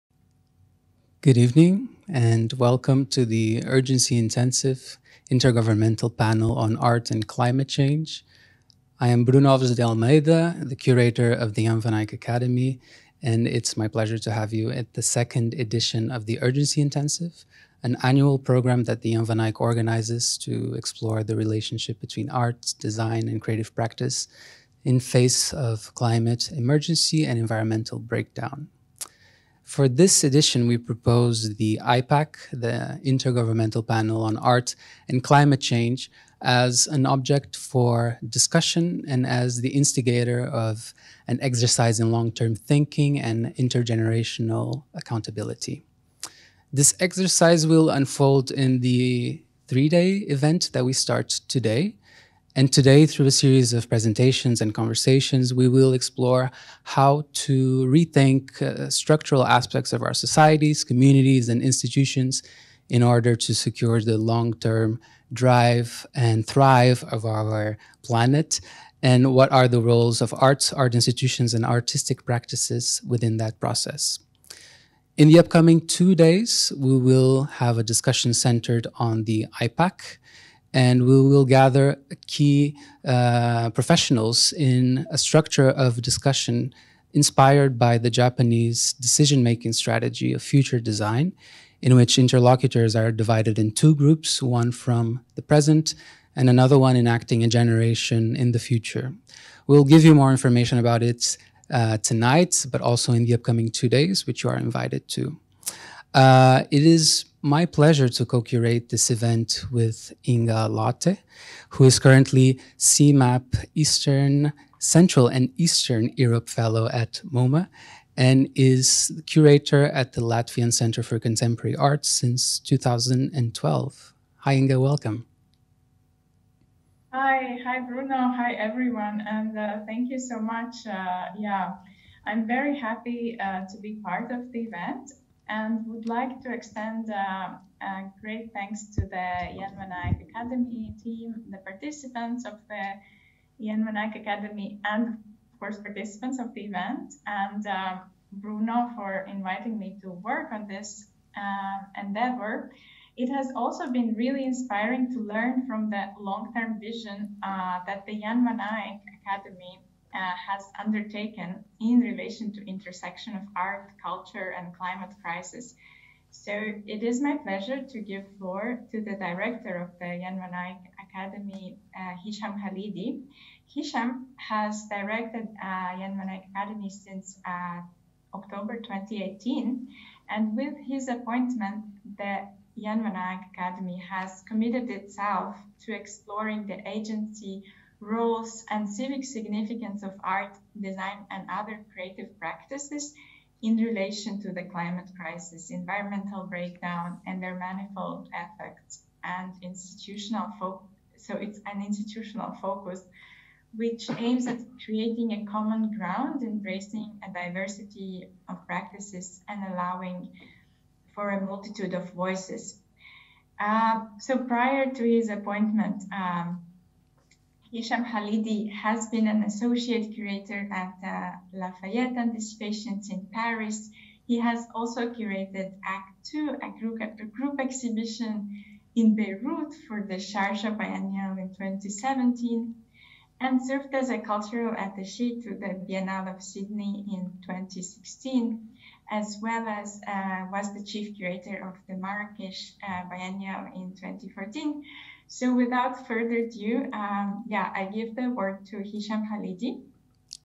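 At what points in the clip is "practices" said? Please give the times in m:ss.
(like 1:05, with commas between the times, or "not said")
0:23, 1:12, 3:12, 3:28.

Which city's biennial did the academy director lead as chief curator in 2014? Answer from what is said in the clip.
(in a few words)
Marrakesh.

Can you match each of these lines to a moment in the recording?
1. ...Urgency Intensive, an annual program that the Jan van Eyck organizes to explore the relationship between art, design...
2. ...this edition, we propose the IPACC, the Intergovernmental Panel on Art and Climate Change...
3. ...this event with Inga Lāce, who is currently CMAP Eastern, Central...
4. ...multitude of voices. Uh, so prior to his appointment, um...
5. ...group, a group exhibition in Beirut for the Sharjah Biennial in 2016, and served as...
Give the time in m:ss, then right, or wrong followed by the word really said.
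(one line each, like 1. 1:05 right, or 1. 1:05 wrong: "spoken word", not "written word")
1. 0:16 right
2. 0:29 right
3. 1:48 right
4. 3:31 right
5. 3:46 wrong: "2017", not "2016".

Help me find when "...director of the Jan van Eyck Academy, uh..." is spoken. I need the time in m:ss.
2:49.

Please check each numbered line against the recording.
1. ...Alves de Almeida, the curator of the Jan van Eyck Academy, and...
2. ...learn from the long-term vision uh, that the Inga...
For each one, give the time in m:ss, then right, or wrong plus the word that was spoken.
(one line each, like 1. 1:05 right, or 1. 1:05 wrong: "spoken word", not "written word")
1. 0:09 right
2. 2:35 wrong: "Jan", not "Inga".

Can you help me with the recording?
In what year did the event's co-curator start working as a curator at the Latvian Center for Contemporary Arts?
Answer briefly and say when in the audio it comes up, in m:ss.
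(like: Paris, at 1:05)
2012, at 2:02.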